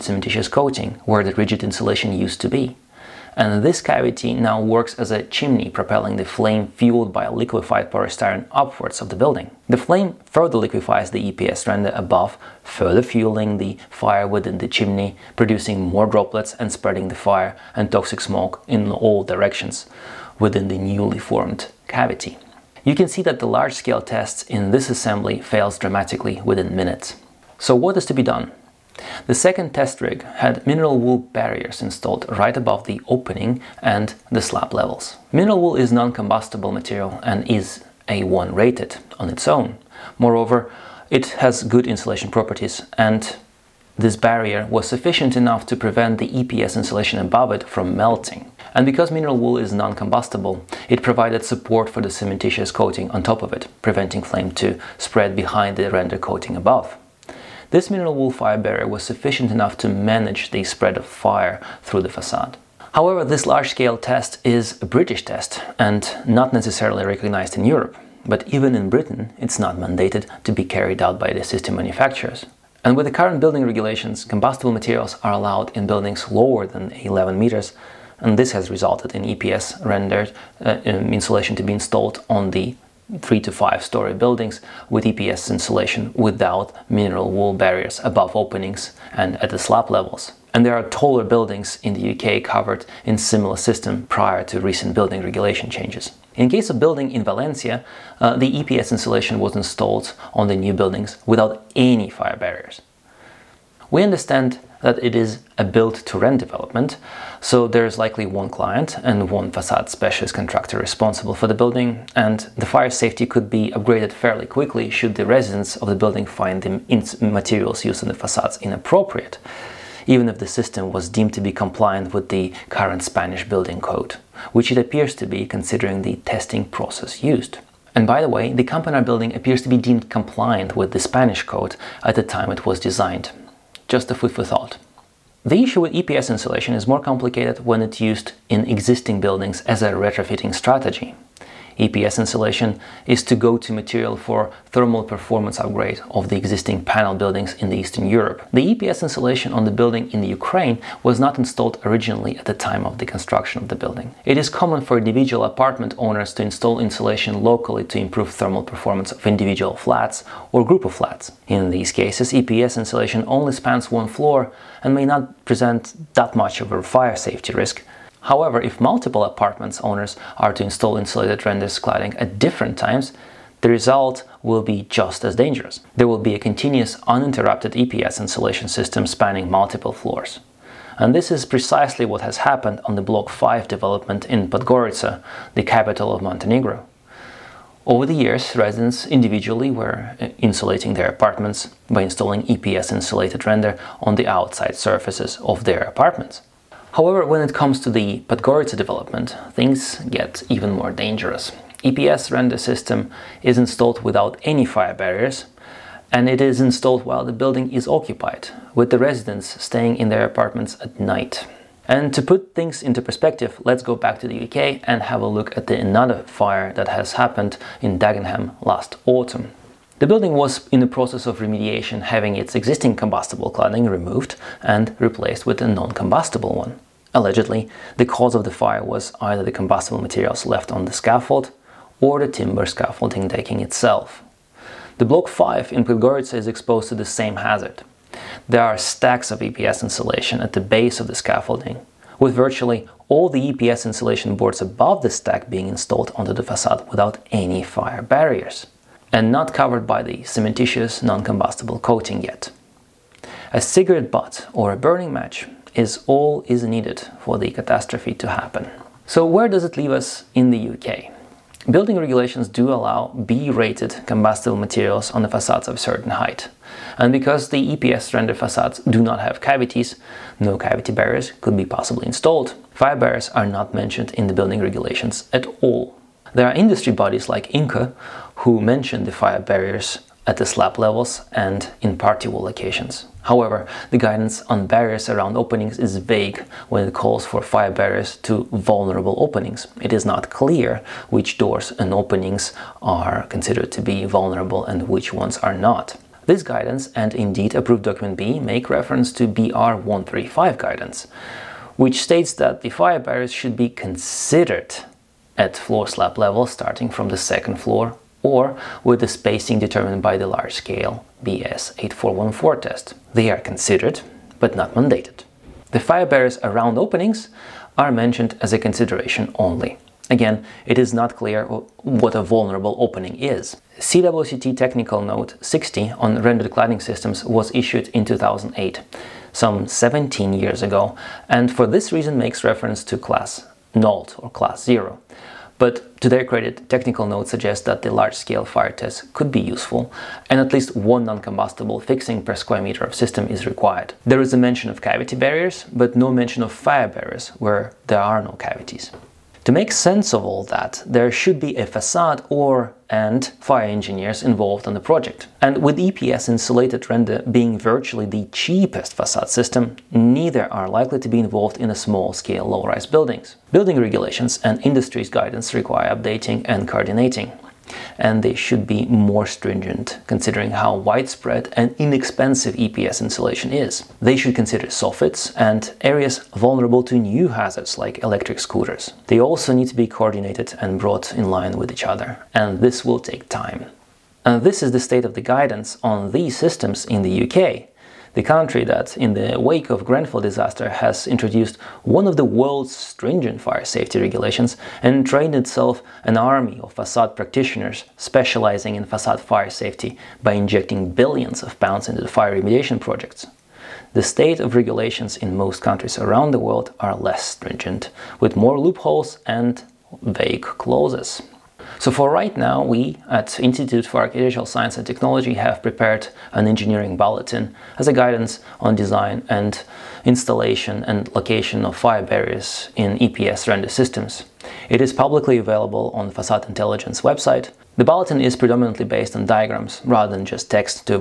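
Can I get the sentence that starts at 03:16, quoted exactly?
However, when it comes to the Podgorica development, things get even more dangerous.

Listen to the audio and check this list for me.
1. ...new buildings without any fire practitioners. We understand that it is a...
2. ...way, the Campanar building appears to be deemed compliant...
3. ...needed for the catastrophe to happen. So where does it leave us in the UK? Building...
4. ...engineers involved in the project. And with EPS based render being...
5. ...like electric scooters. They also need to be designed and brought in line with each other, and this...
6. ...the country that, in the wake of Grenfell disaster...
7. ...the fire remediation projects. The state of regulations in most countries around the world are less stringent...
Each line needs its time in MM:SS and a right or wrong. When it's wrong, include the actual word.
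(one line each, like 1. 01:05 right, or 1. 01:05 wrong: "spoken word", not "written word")
1. 01:40 wrong: "barriers", not "practitioners"
2. 02:08 right
3. 04:16 right
4. 05:53 wrong: "insulated", not "based"
5. 06:17 wrong: "coordinated", not "designed"
6. 06:28 right
7. 06:42 right.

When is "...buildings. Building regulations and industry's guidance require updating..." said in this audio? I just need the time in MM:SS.
06:02.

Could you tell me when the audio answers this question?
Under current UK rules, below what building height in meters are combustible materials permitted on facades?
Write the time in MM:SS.
01:16.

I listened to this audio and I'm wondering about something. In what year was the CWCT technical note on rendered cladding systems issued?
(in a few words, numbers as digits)
2008.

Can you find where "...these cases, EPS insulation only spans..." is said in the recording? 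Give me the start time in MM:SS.
02:41.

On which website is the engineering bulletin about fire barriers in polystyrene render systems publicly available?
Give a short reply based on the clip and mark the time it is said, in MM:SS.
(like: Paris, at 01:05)
Facade Intelligence, at 07:06.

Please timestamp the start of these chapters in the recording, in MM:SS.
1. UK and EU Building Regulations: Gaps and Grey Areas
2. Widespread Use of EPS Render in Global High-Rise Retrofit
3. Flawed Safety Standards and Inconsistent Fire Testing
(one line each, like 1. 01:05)
1. 02:29
2. 04:31
3. 06:33.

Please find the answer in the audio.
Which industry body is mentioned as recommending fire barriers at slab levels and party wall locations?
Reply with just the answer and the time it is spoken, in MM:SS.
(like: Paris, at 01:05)
INCA, at 04:37.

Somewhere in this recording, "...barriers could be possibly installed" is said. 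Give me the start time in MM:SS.
04:30.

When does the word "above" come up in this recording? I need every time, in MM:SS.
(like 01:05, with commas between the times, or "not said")
00:11, 00:32, 00:47, 00:56, 01:28, 04:04.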